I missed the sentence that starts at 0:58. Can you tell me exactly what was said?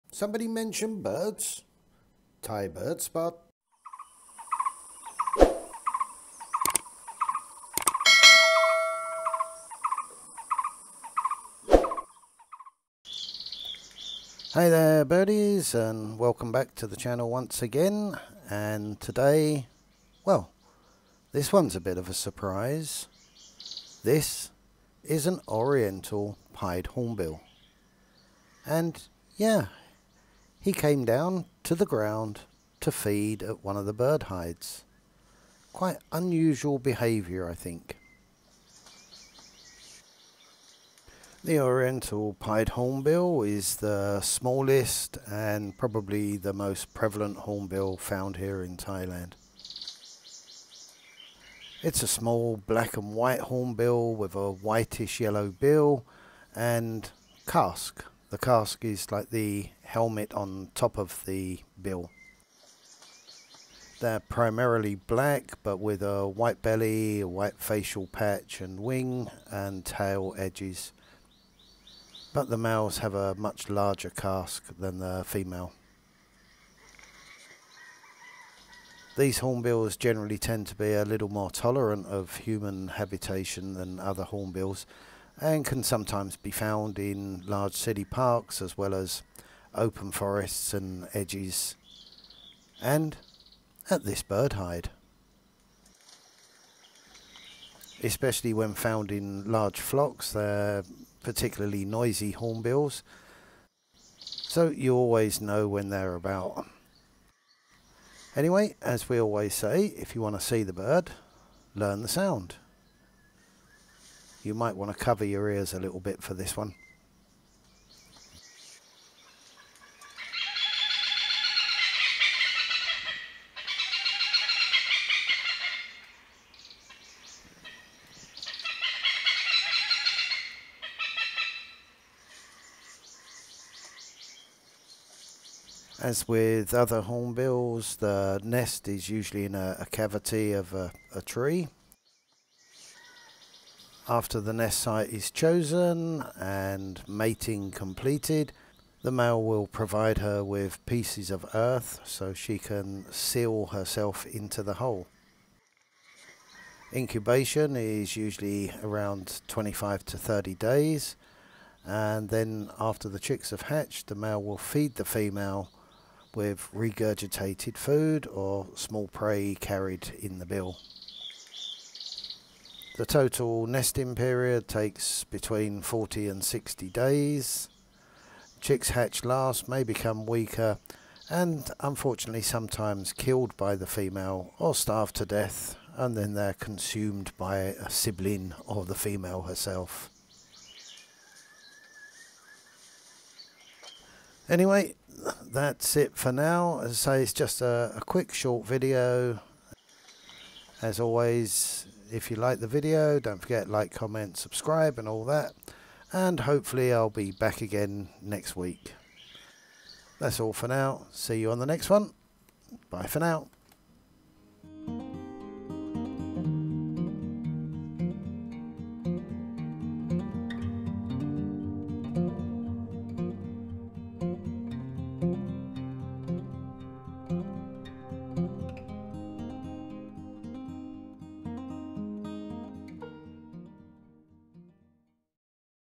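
The casque is like the helmet on top of the bill.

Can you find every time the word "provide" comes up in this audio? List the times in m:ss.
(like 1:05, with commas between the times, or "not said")
2:29.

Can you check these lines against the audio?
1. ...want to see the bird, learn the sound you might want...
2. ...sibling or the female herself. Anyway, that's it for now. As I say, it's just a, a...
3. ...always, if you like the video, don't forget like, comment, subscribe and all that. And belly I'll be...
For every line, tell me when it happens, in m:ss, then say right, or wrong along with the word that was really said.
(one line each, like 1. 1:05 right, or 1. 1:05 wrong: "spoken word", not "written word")
1. 1:50 right
2. 3:07 right
3. 3:20 wrong: "hopefully", not "belly".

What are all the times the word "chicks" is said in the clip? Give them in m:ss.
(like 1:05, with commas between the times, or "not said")
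2:43, 2:58.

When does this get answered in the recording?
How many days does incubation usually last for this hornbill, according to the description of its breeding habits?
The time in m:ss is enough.
2:39.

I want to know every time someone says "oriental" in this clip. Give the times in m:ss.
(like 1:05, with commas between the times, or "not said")
0:25, 0:41.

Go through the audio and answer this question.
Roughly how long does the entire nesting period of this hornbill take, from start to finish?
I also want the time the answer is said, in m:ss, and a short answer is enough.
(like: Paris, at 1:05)
40 to 60 days, at 2:55.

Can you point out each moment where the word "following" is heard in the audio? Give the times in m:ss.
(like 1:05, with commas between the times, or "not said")
not said.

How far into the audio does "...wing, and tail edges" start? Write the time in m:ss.
1:08.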